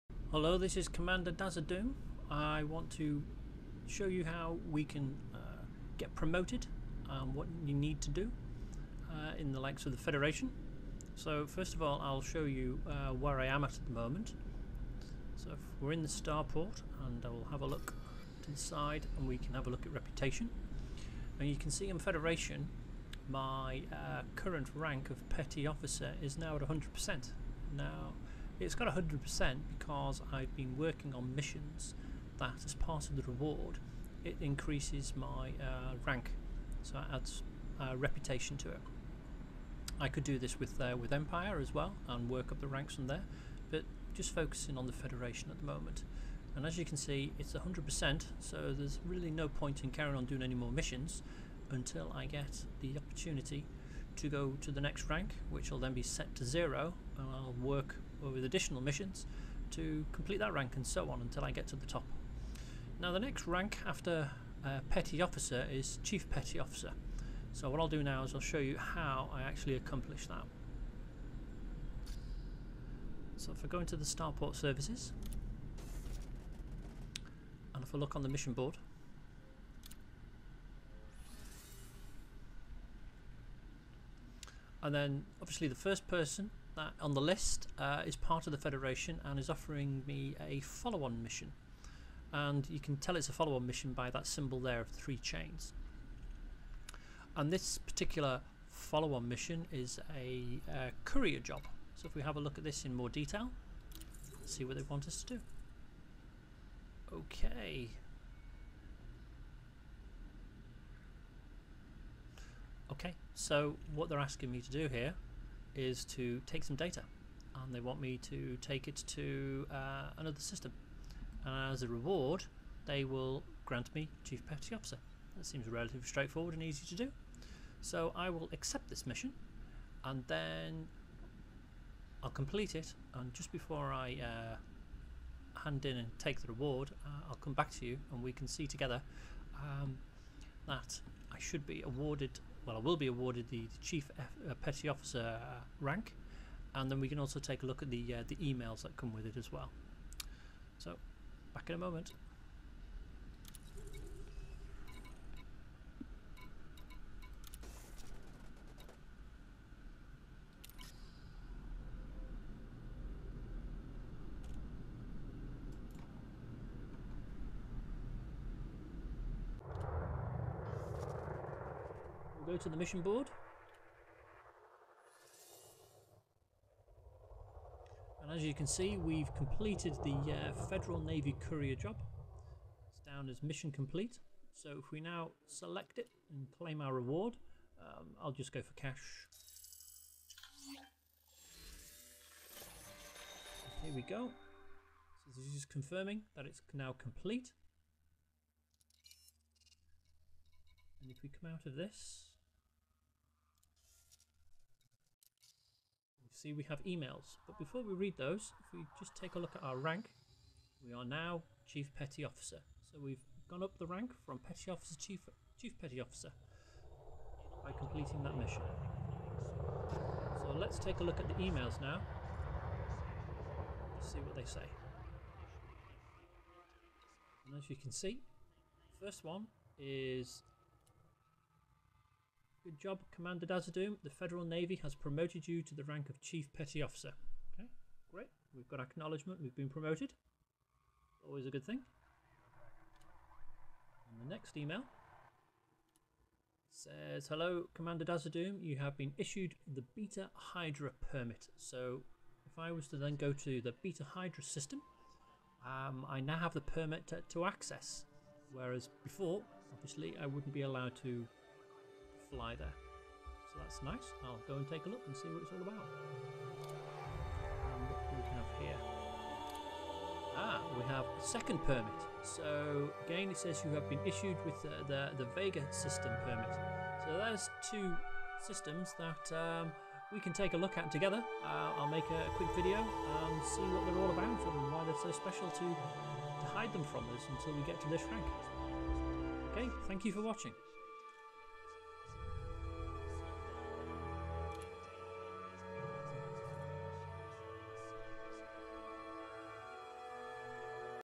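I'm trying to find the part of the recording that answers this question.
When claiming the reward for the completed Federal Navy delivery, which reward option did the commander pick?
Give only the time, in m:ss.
3:08.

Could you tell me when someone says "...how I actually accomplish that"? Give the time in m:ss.
1:08.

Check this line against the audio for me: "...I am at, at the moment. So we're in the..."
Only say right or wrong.
right.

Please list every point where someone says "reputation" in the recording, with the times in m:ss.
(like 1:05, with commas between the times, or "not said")
0:19, 0:37.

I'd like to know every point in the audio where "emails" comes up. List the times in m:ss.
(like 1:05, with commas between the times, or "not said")
2:28, 3:26, 3:41, 4:04.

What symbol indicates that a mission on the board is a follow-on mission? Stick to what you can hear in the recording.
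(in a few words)
Three chains.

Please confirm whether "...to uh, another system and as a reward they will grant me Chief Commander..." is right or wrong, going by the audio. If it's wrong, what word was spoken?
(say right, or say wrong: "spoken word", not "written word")
wrong: "Petty", not "Commander".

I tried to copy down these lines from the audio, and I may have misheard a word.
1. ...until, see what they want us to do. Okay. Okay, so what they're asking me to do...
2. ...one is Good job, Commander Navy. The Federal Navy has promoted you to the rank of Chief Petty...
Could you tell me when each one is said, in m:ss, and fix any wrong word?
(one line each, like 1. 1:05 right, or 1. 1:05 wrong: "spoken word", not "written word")
1. 1:43 wrong: "detail", not "until"
2. 3:49 wrong: "Dazadum", not "Navy".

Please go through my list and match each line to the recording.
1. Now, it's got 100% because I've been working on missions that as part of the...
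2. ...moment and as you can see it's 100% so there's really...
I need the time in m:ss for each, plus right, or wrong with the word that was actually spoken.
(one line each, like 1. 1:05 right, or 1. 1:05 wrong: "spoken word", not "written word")
1. 0:27 right
2. 0:45 right.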